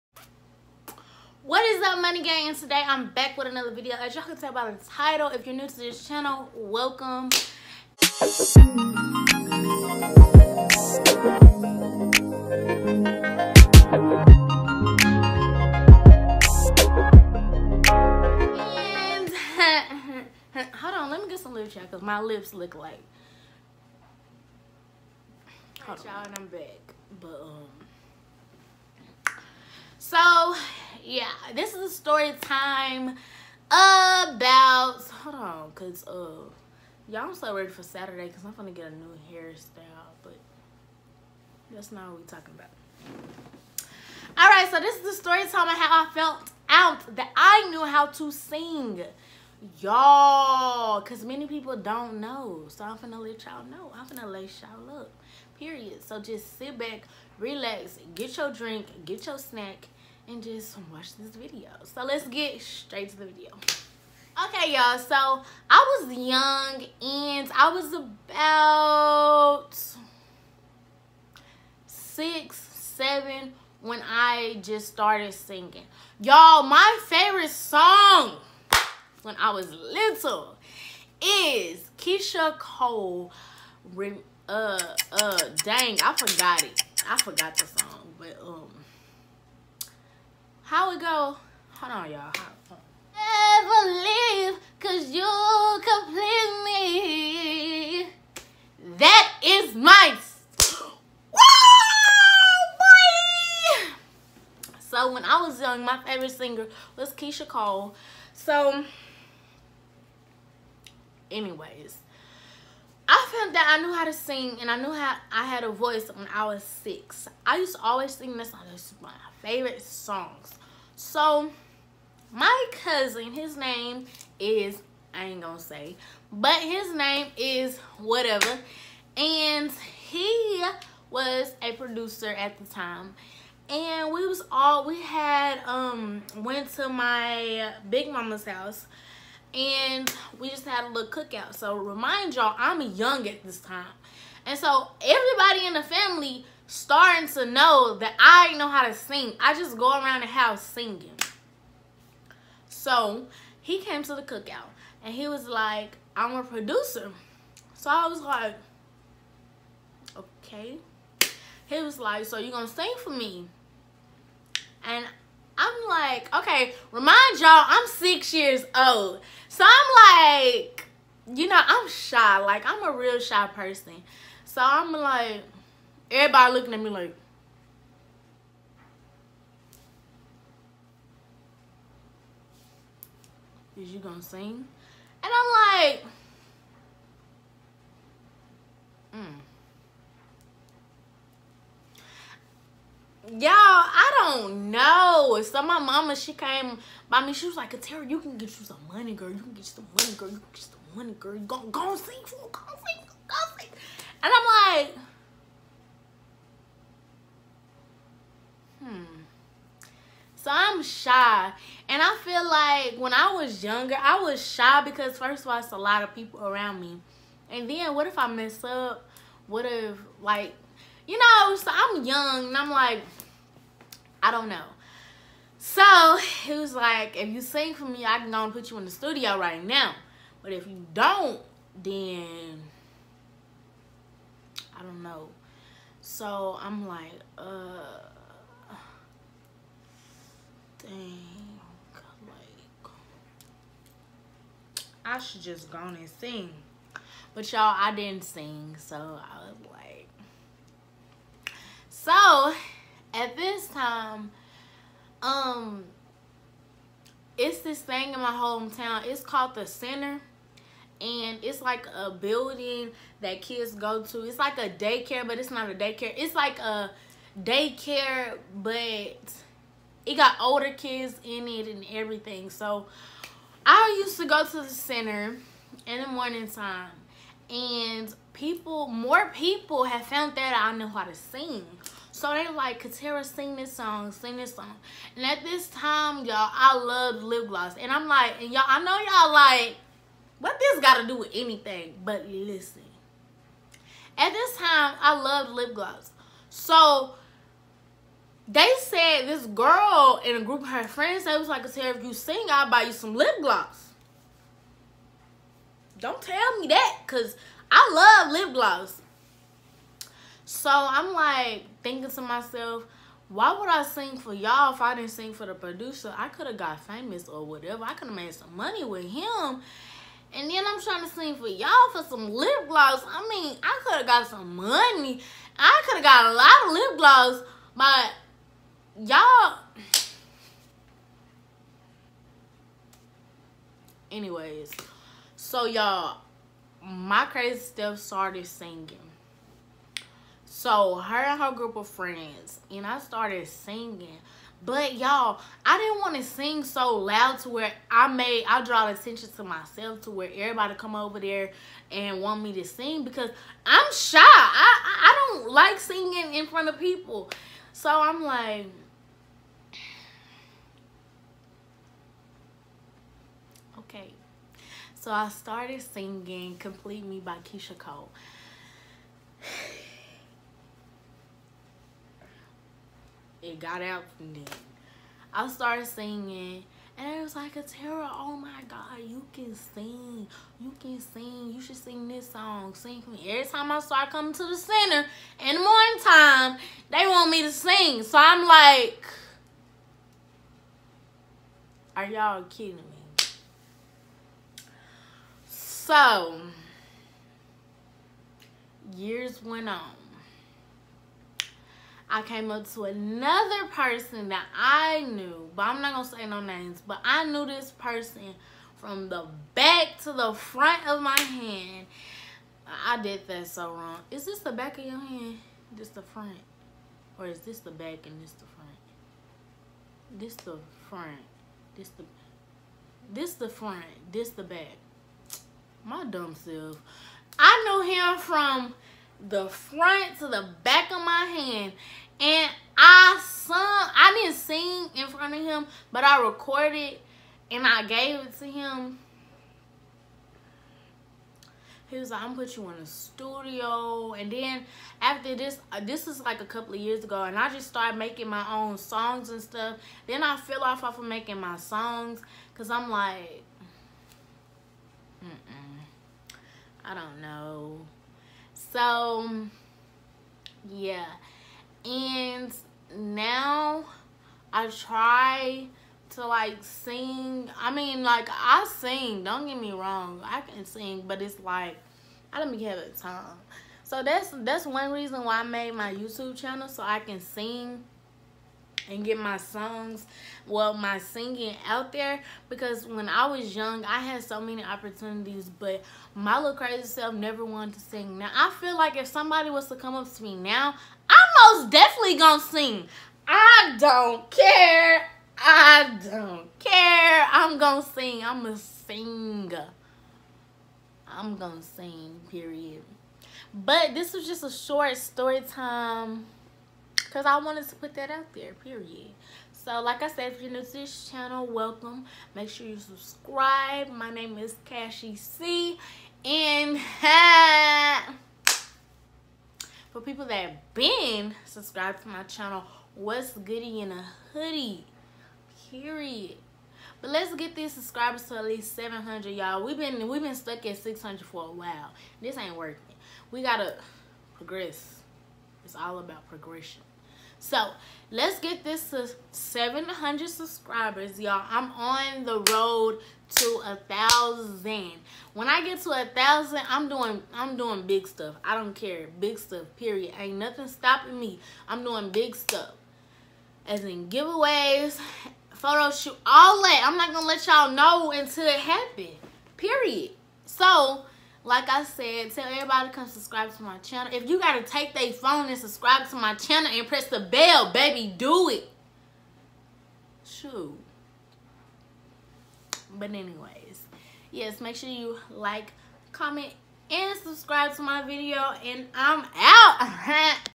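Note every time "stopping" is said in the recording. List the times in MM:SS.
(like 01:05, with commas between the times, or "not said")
09:10.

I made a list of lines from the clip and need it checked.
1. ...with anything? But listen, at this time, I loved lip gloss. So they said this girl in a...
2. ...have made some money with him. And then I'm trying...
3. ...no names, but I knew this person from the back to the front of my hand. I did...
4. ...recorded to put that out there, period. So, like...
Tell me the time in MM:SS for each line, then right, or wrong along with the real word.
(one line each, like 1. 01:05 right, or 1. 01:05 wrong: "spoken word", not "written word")
1. 04:51 right
2. 05:18 right
3. 06:46 right
4. 08:27 wrong: "wanted", not "recorded".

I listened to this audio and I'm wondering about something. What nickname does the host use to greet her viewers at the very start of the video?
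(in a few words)
Money Gang.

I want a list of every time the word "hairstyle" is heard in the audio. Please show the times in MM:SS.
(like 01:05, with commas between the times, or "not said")
00:39.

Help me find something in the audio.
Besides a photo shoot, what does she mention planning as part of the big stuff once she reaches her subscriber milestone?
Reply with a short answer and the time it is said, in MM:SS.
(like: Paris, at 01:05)
Giveaways, at 09:14.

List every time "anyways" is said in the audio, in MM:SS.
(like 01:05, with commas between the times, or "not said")
01:51, 05:34, 09:33.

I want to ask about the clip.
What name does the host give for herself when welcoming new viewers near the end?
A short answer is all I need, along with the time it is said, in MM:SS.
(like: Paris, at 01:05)
Cashie C, at 08:34.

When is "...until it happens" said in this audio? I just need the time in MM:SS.
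09:18.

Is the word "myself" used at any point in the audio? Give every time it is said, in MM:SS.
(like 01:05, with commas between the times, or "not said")
05:12, 05:49.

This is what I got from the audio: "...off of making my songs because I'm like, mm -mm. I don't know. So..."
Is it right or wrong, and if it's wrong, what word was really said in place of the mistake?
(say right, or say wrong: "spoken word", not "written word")
right.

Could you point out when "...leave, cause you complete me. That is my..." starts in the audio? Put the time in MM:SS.
01:34.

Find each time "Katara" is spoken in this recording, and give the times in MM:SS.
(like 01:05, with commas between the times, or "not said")
03:17, 04:42, 06:17.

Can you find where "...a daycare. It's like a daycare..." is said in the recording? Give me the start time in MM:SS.
04:25.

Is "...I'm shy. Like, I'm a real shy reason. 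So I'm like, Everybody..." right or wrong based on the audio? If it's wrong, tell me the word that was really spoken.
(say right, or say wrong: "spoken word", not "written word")
wrong: "person", not "reason".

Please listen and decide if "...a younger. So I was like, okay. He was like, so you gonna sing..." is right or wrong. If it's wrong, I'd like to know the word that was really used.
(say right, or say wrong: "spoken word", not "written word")
wrong: "producer", not "younger".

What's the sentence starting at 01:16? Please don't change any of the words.
Y'all, my favorite song when I was little is Keyshia Cole.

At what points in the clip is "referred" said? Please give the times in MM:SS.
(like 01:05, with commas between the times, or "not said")
not said.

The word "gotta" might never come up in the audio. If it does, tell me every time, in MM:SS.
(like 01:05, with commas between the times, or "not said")
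08:53, 09:24.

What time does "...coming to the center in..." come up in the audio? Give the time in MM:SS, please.
06:24.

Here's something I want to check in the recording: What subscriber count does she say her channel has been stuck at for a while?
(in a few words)
600.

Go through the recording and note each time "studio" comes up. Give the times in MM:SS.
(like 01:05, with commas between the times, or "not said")
03:48, 07:22.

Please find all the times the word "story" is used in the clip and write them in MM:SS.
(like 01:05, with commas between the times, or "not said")
00:31, 00:45, 08:24.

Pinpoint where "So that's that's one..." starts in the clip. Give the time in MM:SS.
07:53.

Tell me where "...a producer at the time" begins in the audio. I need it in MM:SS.
02:11.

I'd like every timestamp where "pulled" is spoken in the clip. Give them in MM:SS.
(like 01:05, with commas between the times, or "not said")
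not said.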